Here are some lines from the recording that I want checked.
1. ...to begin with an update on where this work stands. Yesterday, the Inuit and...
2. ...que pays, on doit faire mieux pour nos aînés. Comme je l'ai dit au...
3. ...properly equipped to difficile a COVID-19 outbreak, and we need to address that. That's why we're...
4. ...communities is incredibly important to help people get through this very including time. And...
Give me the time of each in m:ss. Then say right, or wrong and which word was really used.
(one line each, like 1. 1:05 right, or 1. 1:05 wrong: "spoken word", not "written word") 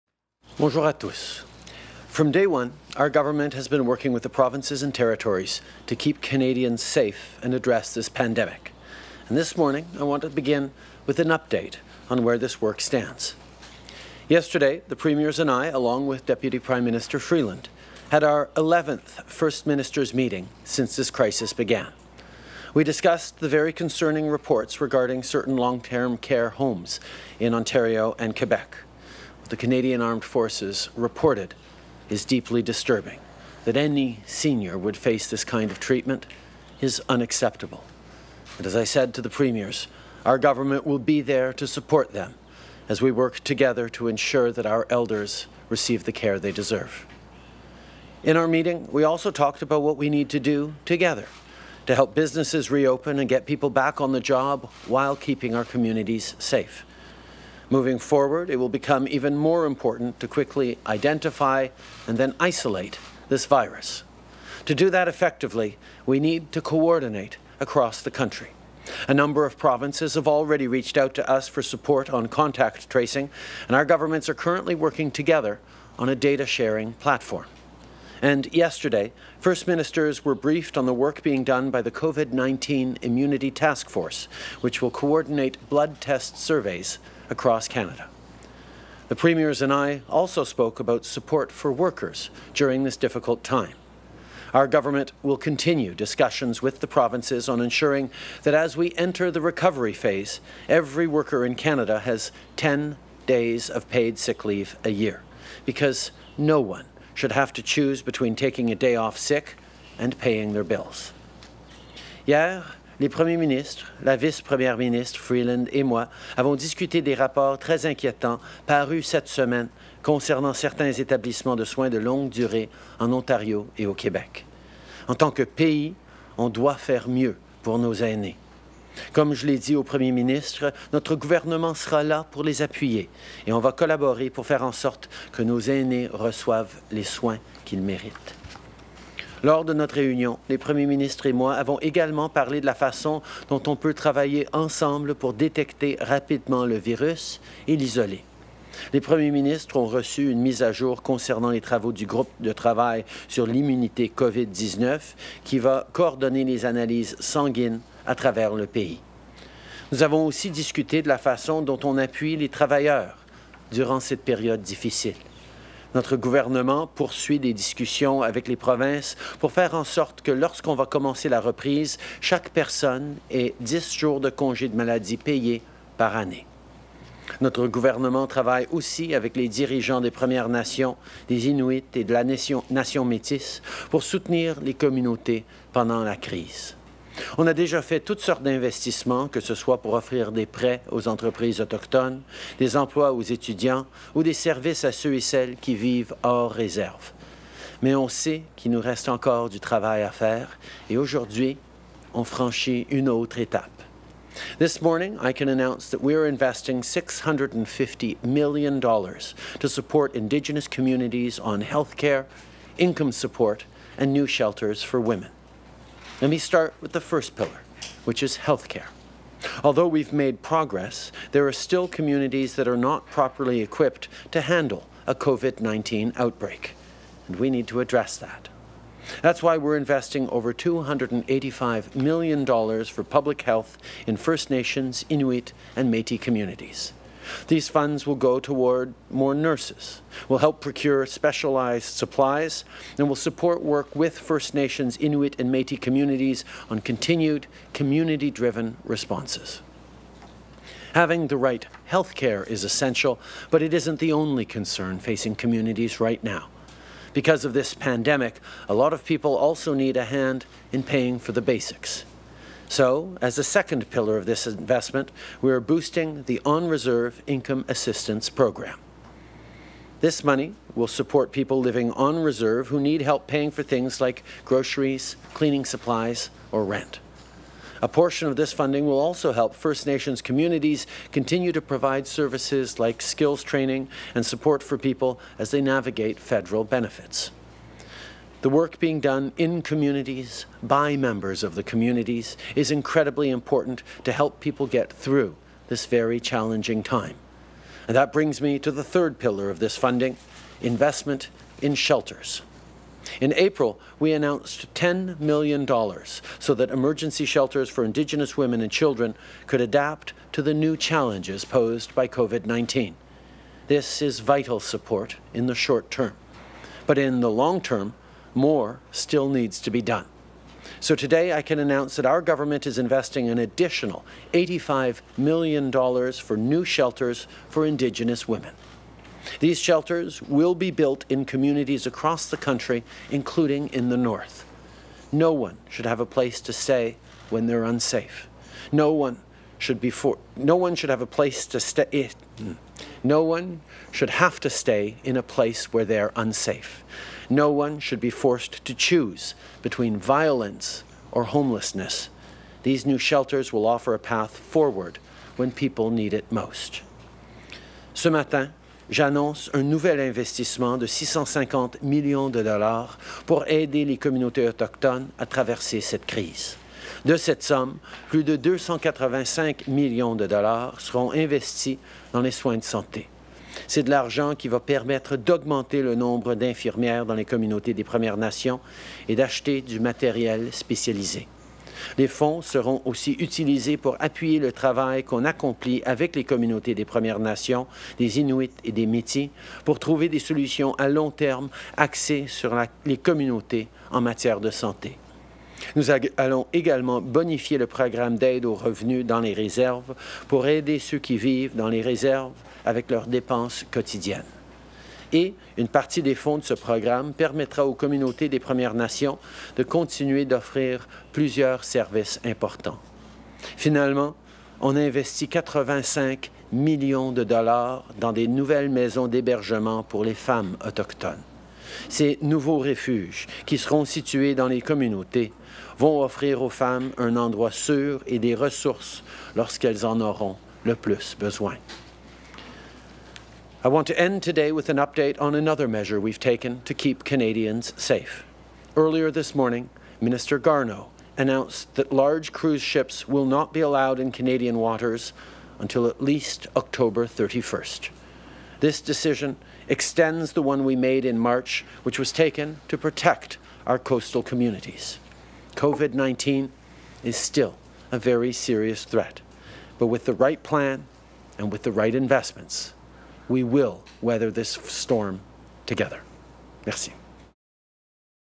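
1. 0:10 wrong: "Premiers", not "Inuit"
2. 2:05 right
3. 3:43 wrong: "handle", not "difficile"
4. 4:51 wrong: "challenging", not "including".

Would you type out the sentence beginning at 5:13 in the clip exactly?
This is vital support in the short term.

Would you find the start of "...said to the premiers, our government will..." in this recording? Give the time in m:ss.
0:38.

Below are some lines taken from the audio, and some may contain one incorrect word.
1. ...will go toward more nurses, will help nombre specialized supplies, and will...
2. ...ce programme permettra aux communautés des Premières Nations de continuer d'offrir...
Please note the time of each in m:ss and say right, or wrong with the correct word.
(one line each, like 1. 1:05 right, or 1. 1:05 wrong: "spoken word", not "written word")
1. 3:58 wrong: "procure", not "nombre"
2. 6:46 right.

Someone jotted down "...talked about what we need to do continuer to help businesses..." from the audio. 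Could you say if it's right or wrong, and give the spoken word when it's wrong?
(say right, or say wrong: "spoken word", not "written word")
wrong: "together", not "continuer".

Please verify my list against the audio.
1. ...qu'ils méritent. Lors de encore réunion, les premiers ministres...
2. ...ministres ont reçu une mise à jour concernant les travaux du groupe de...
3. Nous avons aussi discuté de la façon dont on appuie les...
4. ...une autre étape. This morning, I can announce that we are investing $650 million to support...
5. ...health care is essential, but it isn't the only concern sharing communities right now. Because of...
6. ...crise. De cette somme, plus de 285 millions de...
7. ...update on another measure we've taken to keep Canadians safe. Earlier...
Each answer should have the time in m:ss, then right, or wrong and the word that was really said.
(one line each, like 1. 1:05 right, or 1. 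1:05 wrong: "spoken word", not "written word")
1. 2:17 wrong: "notre", not "encore"
2. 2:29 right
3. 2:39 right
4. 3:22 right
5. 4:11 wrong: "facing", not "sharing"
6. 6:06 right
7. 7:14 right.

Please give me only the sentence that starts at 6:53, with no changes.
Finalement, on investit 85 millions de dollars dans des nouvelles maisons d'hébergement pour les femmes autochtones.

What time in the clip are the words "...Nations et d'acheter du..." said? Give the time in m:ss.
6:18.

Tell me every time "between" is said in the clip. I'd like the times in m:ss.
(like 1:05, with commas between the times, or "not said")
1:48, 5:49.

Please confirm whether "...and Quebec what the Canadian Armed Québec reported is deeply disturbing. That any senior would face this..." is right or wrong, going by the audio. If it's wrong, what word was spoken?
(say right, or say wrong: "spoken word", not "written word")
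wrong: "Forces", not "Québec".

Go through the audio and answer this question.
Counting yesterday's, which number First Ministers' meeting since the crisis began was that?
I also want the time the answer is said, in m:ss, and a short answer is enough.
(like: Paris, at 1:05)
11th, at 0:18.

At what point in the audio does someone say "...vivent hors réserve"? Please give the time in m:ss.
3:15.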